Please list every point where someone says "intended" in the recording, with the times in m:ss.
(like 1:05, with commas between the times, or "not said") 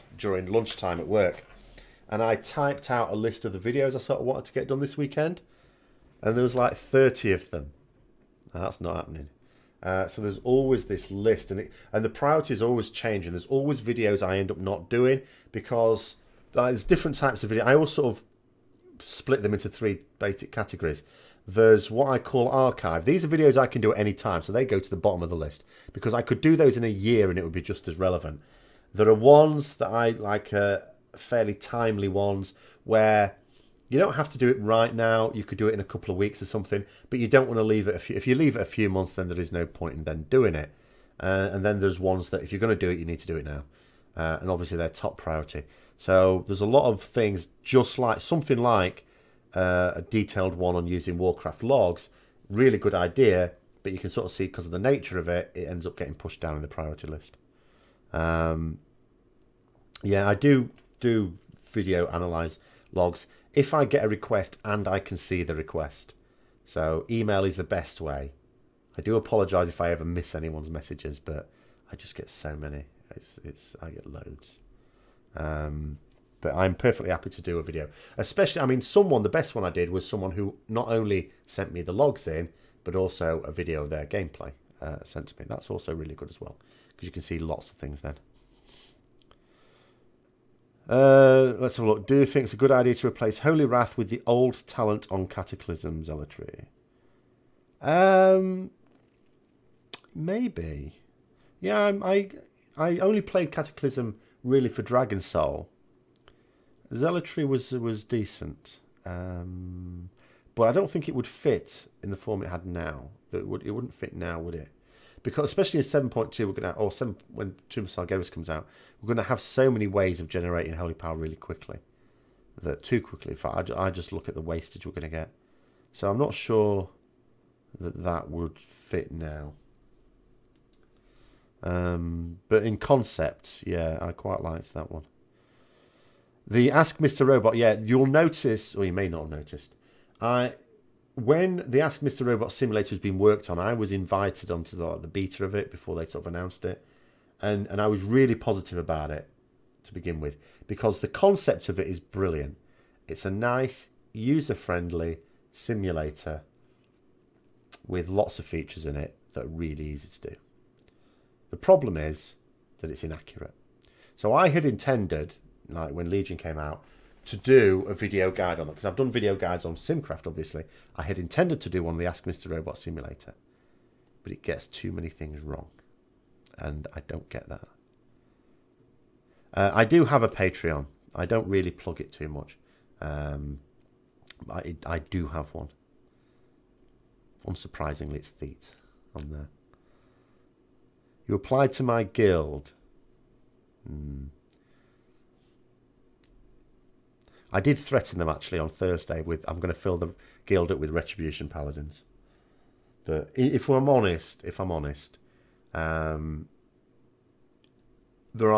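2:44, 2:51.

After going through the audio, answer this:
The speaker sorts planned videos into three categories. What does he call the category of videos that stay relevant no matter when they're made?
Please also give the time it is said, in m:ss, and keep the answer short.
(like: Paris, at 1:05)
archive, at 0:22.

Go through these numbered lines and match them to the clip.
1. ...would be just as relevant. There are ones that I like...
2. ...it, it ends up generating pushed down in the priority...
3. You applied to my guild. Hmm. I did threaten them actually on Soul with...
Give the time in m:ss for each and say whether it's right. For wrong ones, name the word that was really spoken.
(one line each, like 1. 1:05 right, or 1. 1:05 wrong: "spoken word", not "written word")
1. 0:27 right
2. 0:55 wrong: "getting", not "generating"
3. 3:11 wrong: "Thursday", not "Soul".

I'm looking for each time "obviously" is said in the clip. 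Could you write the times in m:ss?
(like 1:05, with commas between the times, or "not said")
0:44, 2:50.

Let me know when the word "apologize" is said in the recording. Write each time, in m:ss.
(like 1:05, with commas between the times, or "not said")
1:09.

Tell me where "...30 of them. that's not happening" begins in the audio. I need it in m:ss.
0:06.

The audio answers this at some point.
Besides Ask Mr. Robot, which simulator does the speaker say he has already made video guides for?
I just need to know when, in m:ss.
2:49.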